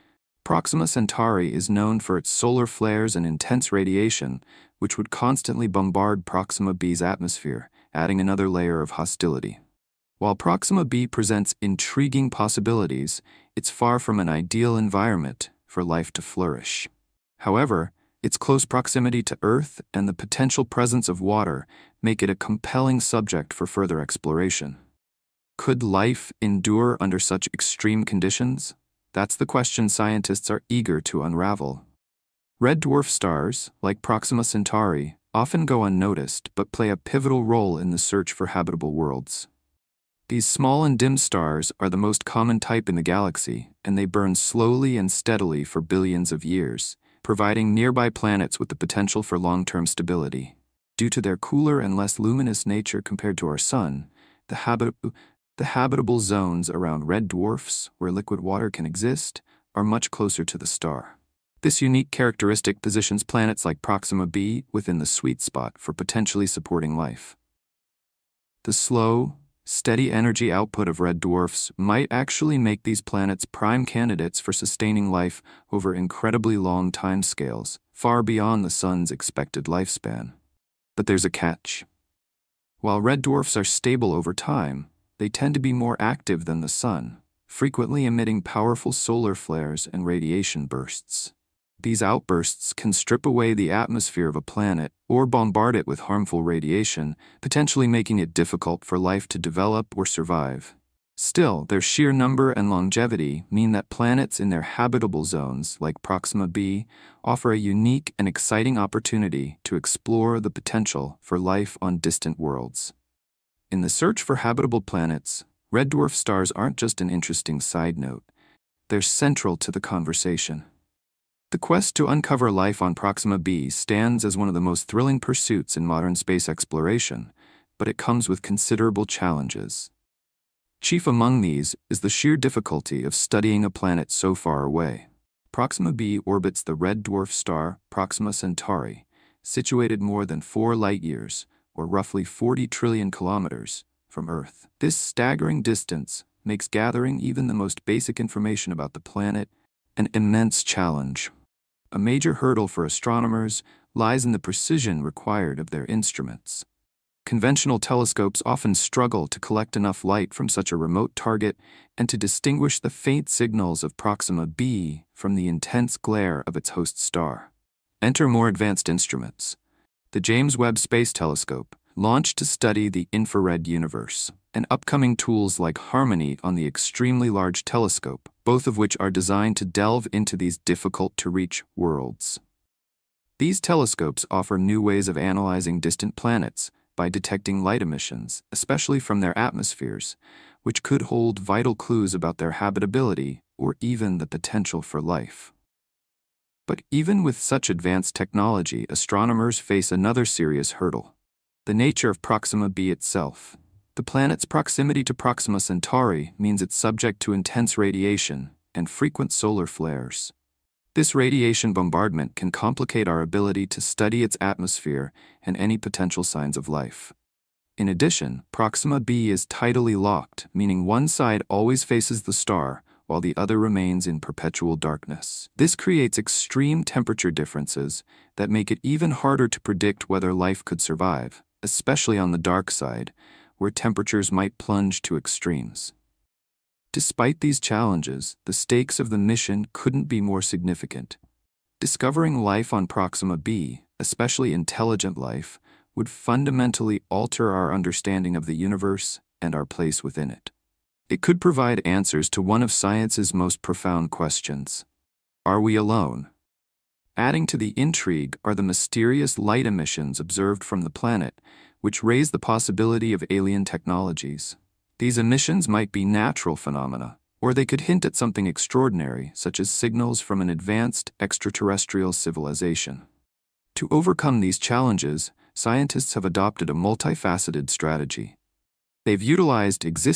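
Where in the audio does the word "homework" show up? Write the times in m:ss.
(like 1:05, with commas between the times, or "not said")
not said.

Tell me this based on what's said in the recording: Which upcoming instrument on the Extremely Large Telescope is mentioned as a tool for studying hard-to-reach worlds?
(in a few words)
HARMONI.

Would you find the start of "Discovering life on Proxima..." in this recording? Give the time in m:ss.
4:01.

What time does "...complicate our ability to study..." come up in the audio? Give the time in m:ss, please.
3:32.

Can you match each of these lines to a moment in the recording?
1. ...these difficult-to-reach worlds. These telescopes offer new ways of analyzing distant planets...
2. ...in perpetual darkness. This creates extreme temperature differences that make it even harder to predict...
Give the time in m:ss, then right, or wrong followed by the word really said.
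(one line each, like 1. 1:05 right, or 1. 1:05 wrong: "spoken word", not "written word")
1. 3:00 right
2. 3:44 right.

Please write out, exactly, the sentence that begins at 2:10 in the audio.
Chief among these is the sheer difficulty of studying a planet so far away.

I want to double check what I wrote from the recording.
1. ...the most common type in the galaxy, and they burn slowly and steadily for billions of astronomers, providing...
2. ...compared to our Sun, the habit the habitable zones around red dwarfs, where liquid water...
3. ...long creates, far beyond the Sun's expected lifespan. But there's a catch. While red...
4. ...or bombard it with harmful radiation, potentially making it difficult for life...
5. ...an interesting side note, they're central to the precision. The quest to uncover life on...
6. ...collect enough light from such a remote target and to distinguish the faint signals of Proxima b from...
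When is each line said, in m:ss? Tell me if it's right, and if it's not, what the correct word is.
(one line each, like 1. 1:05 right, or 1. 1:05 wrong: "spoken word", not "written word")
1. 0:41 wrong: "years", not "astronomers"
2. 0:53 right
3. 1:16 wrong: "timescales", not "creates"
4. 1:35 right
5. 1:57 wrong: "conversation", not "precision"
6. 2:39 right.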